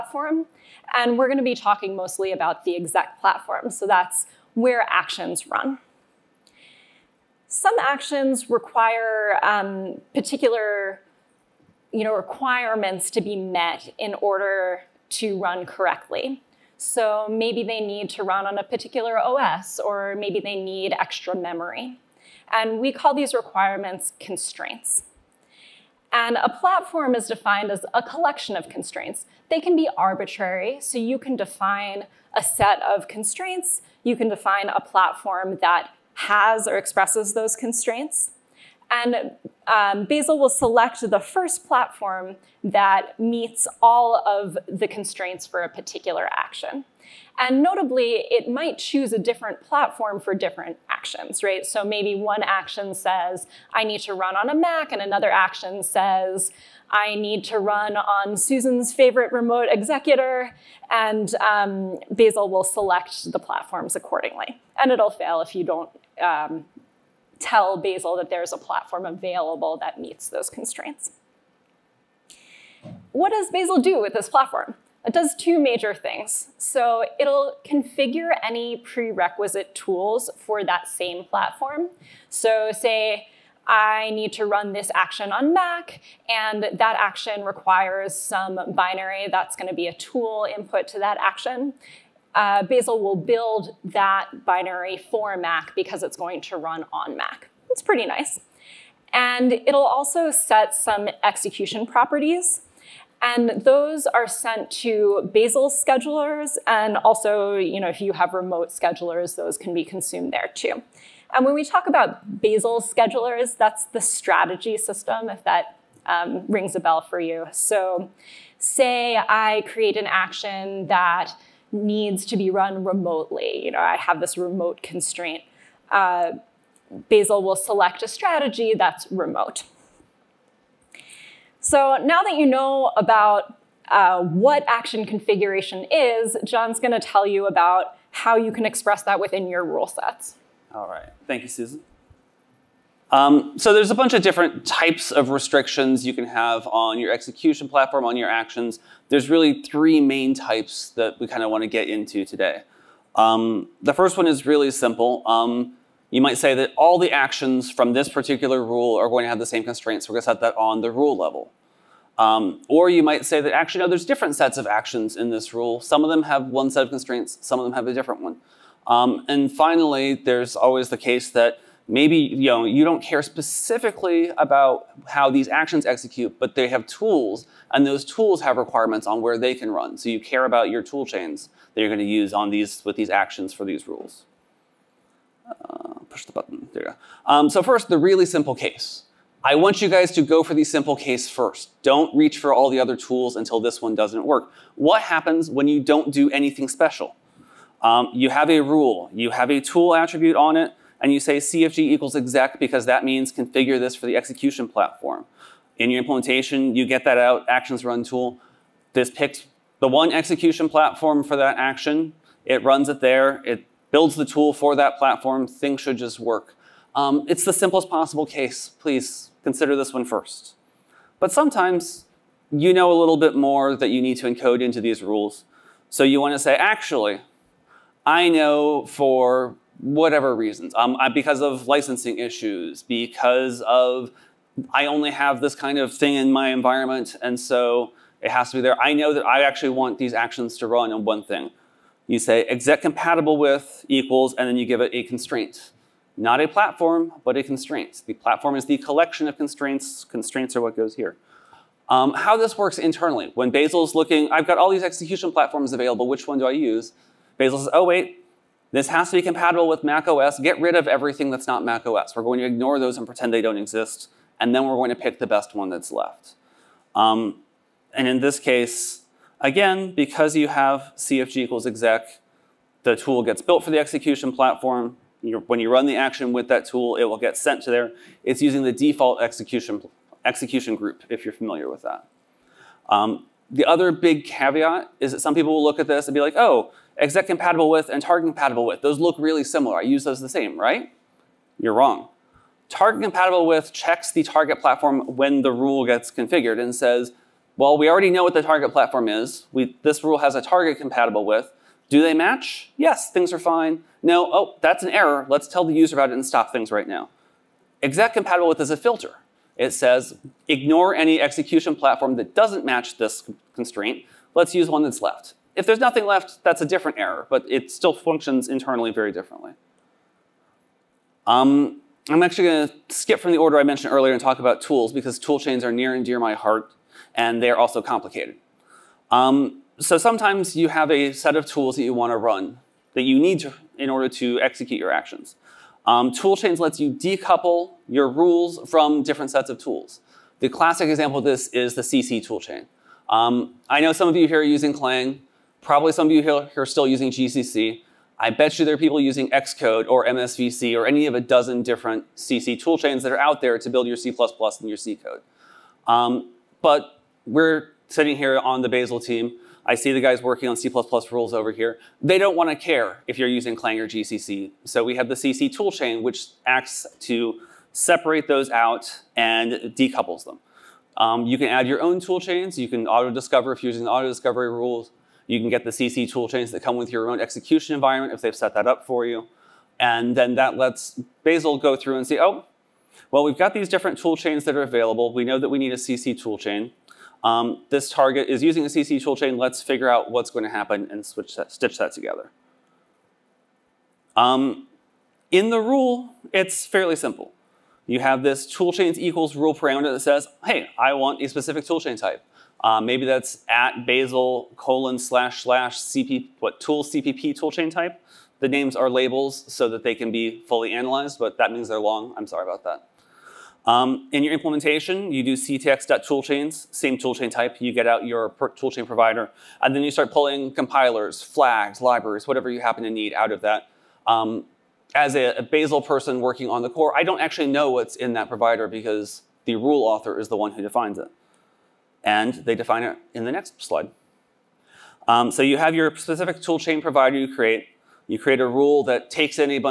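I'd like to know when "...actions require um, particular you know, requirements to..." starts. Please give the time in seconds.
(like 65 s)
7 s.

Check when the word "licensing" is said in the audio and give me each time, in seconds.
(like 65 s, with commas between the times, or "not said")
231 s.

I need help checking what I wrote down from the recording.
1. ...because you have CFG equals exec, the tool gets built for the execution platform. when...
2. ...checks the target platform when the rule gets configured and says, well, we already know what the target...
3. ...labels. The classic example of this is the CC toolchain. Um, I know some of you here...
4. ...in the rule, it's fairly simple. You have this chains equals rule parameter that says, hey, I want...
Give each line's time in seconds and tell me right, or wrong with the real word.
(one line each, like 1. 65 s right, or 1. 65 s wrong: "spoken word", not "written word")
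1. 269 s right
2. 293 s right
3. 339 s wrong: "tools", not "labels"
4. 395 s right.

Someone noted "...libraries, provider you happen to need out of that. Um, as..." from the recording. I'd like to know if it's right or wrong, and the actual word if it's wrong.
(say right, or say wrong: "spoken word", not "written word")
wrong: "whatever", not "provider".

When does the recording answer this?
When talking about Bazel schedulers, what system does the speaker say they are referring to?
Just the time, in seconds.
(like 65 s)
113 s.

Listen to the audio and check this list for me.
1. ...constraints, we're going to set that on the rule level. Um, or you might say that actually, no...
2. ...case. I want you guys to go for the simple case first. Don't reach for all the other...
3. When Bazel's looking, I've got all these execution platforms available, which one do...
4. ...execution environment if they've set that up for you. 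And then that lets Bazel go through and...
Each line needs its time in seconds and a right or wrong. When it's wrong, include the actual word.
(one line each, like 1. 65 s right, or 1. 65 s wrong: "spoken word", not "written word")
1. 159 s right
2. 188 s right
3. 253 s right
4. 377 s right.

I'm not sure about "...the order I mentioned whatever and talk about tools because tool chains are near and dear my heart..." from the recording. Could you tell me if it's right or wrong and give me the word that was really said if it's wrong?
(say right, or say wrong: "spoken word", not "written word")
wrong: "earlier", not "whatever".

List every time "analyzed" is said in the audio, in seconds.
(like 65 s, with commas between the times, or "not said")
410 s.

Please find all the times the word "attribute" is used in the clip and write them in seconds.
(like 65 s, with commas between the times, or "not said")
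199 s.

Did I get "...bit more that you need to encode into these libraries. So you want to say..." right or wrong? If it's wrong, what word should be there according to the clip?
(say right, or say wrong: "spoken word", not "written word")
wrong: "rules", not "libraries".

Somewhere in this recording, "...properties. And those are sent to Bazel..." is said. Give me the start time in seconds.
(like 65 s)
101 s.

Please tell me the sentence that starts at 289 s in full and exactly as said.
I use those the same, right?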